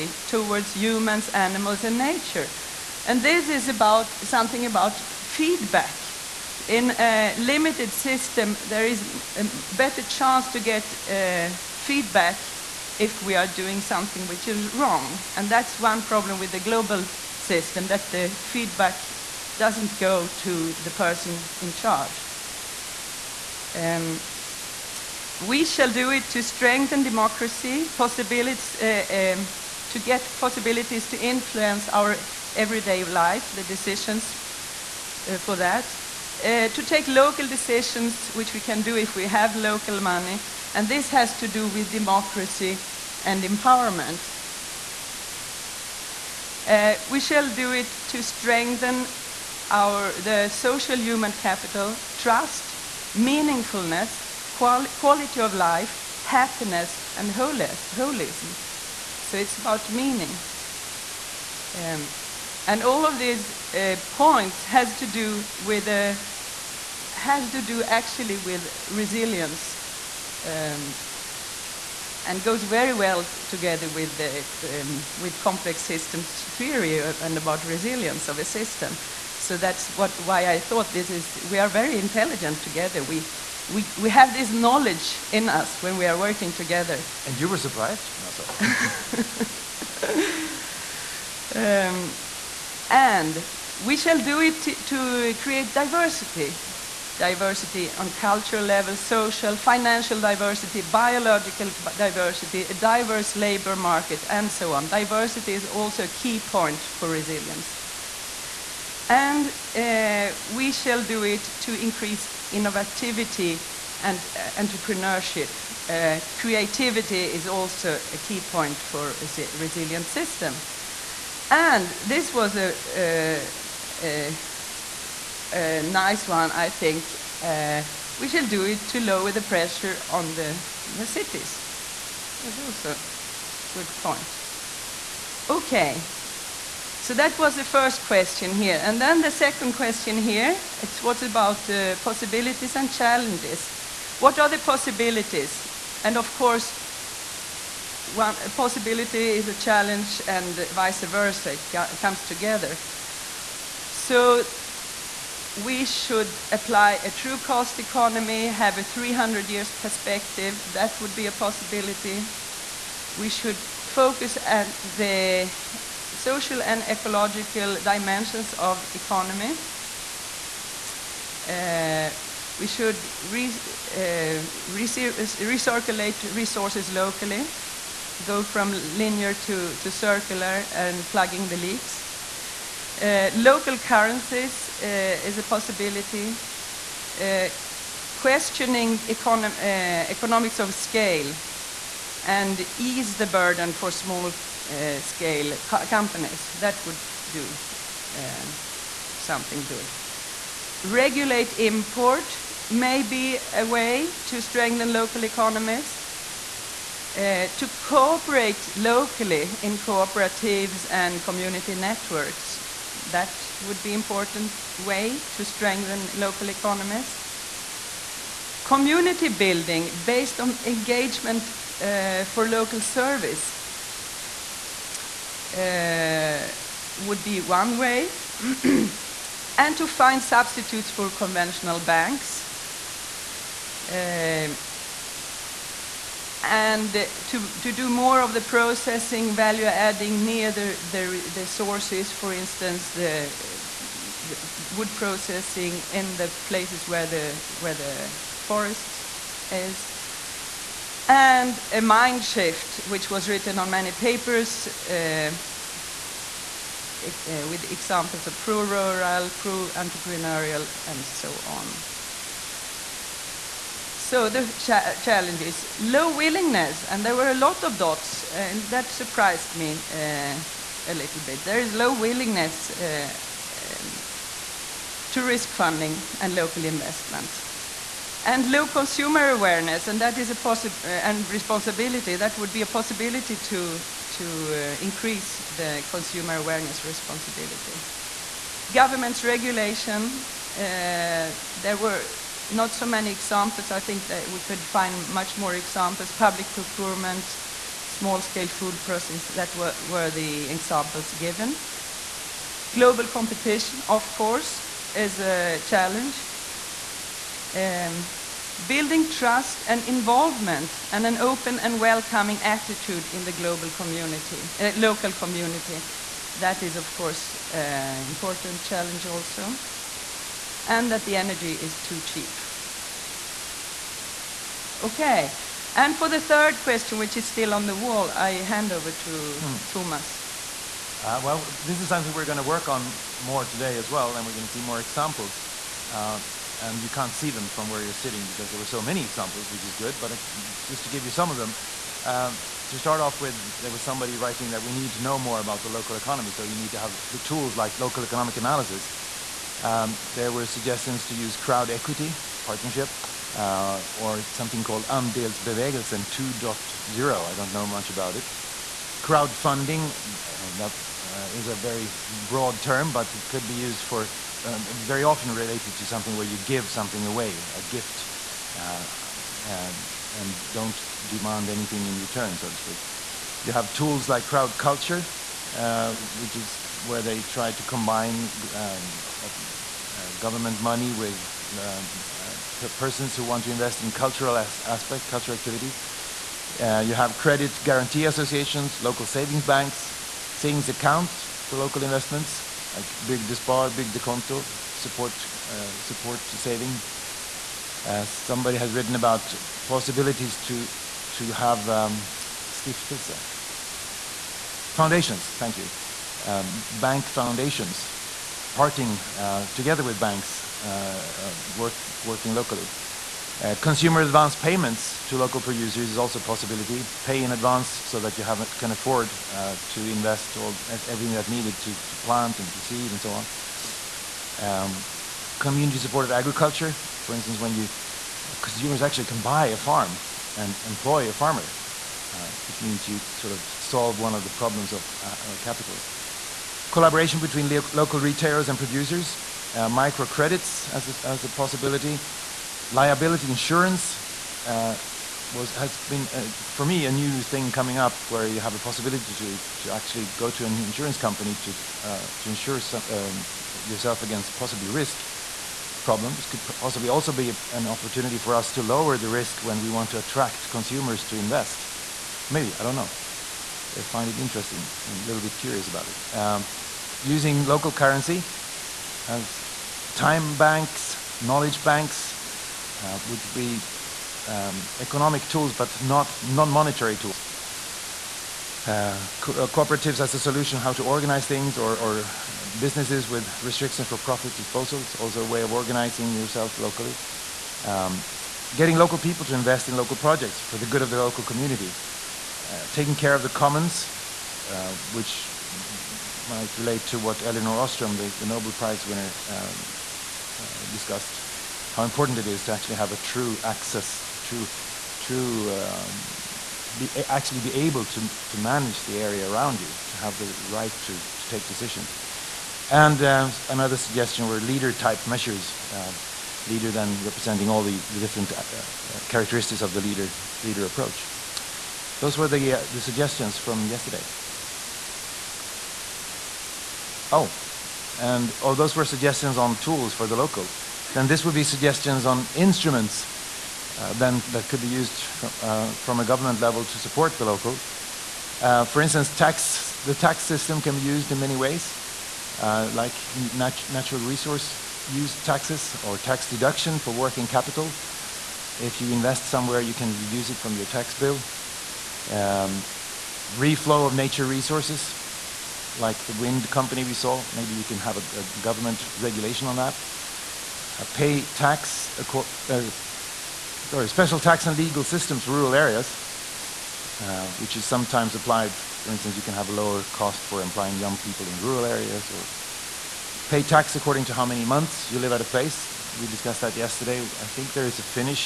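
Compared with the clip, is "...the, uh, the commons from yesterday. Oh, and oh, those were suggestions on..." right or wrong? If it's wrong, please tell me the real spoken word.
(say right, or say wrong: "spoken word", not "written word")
wrong: "suggestions", not "commons".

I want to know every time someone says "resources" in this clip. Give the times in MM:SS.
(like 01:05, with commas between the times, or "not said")
02:56, 09:04, 09:14.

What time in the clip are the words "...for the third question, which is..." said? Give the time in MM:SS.
05:25.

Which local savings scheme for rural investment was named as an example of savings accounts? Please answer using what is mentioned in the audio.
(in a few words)
Bygdespar.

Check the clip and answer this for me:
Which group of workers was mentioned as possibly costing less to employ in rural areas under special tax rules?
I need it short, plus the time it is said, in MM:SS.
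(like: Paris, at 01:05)
Young people, at 09:30.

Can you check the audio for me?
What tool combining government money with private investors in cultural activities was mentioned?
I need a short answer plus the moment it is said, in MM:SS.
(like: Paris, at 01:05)
Crowd culture, at 06:14.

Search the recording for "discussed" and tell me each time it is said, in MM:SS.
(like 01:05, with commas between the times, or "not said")
08:20, 09:36.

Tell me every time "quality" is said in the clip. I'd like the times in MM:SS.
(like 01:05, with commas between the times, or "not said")
00:54.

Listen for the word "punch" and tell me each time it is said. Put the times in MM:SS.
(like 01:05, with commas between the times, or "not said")
not said.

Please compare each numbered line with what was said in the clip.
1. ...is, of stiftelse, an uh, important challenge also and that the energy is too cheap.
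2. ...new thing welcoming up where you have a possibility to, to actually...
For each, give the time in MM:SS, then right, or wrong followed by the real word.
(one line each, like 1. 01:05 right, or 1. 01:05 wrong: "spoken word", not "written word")
1. 05:16 wrong: "course", not "stiftelse"
2. 07:26 wrong: "coming", not "welcoming".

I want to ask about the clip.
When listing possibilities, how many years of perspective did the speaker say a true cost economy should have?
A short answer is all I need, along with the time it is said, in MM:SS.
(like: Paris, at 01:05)
300 years, at 02:38.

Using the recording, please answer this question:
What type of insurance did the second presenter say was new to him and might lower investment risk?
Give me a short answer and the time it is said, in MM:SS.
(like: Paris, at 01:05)
Liability insurance, at 07:22.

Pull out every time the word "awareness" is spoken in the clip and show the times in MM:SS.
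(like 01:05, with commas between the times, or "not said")
04:39, 04:46.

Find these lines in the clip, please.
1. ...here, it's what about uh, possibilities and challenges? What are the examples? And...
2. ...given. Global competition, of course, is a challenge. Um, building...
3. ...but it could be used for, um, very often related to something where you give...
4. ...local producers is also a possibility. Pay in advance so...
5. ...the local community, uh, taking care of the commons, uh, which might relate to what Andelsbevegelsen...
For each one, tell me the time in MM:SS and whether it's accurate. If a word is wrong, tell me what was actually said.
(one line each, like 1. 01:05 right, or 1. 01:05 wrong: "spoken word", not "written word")
1. 02:20 wrong: "possibilities", not "examples"
2. 05:01 right
3. 06:02 right
4. 06:55 right
5. 08:10 wrong: "Elinor", not "Andelsbevegelsen".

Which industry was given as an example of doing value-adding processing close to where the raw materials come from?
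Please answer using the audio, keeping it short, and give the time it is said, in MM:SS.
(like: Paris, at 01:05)
Wood processing, at 04:04.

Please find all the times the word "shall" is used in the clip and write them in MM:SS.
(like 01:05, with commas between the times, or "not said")
00:25, 00:47, 01:33, 01:50, 02:08.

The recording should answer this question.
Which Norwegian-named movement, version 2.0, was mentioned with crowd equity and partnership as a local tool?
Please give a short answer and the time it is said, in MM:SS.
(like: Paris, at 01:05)
Andelsbevegelsen 2.0, at 05:54.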